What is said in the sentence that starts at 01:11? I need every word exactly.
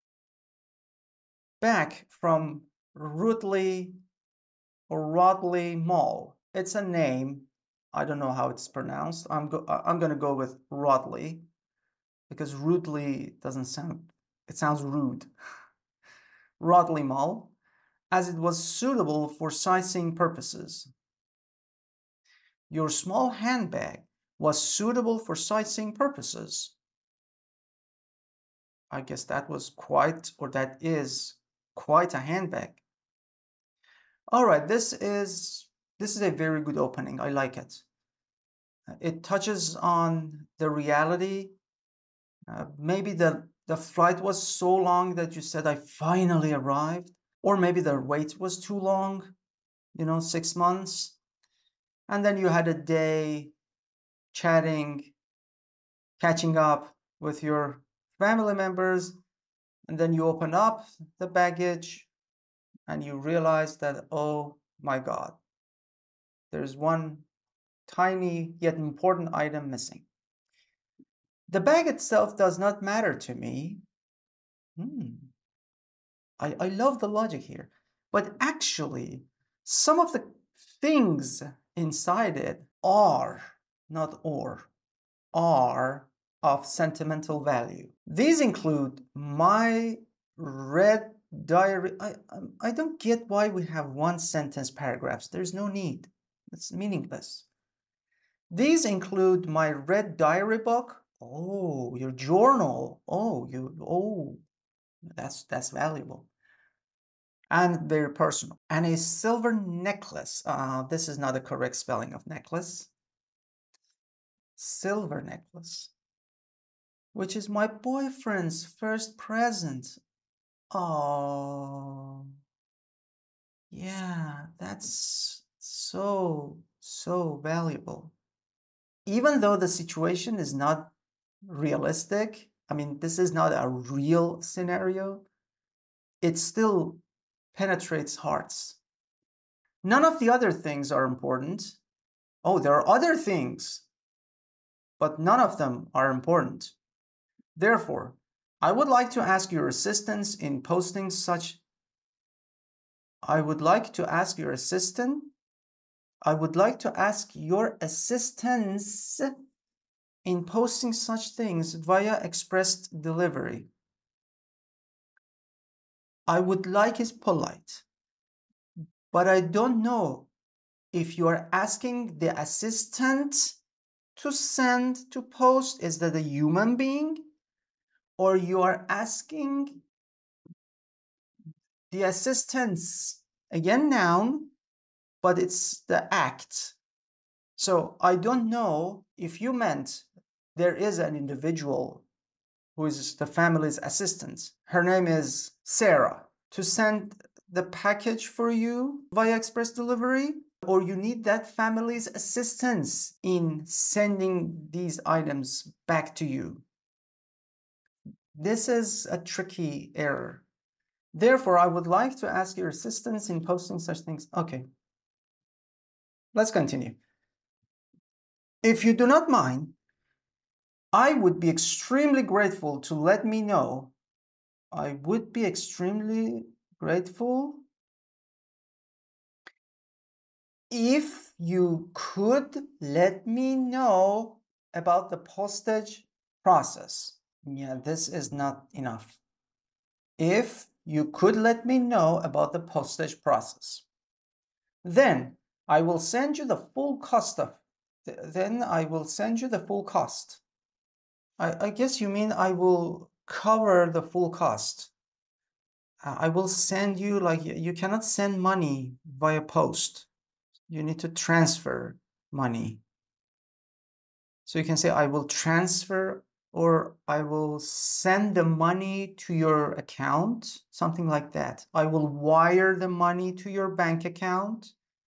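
The bag itself does not matter to me.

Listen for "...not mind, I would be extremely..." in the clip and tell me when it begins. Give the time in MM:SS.
03:39.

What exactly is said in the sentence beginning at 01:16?
I, I love the logic here.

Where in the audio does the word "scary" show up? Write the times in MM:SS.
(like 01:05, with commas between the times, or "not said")
not said.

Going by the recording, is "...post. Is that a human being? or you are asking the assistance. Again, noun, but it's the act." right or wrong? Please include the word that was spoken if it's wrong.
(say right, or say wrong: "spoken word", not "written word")
right.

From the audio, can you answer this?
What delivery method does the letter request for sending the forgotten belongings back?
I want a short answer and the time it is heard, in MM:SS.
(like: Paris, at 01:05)
Express delivery, at 02:41.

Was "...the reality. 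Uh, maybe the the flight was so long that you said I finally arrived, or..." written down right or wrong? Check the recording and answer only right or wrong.
right.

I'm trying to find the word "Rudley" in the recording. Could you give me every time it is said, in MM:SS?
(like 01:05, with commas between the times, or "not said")
00:02, 00:12.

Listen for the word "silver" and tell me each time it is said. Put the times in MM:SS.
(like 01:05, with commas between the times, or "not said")
01:48, 01:54.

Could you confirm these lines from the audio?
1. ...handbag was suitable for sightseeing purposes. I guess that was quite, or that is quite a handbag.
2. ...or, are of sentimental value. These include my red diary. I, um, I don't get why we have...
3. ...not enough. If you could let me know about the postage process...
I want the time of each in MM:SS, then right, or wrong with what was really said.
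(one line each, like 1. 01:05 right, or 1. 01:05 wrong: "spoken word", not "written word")
1. 00:23 right
2. 01:24 right
3. 03:58 right.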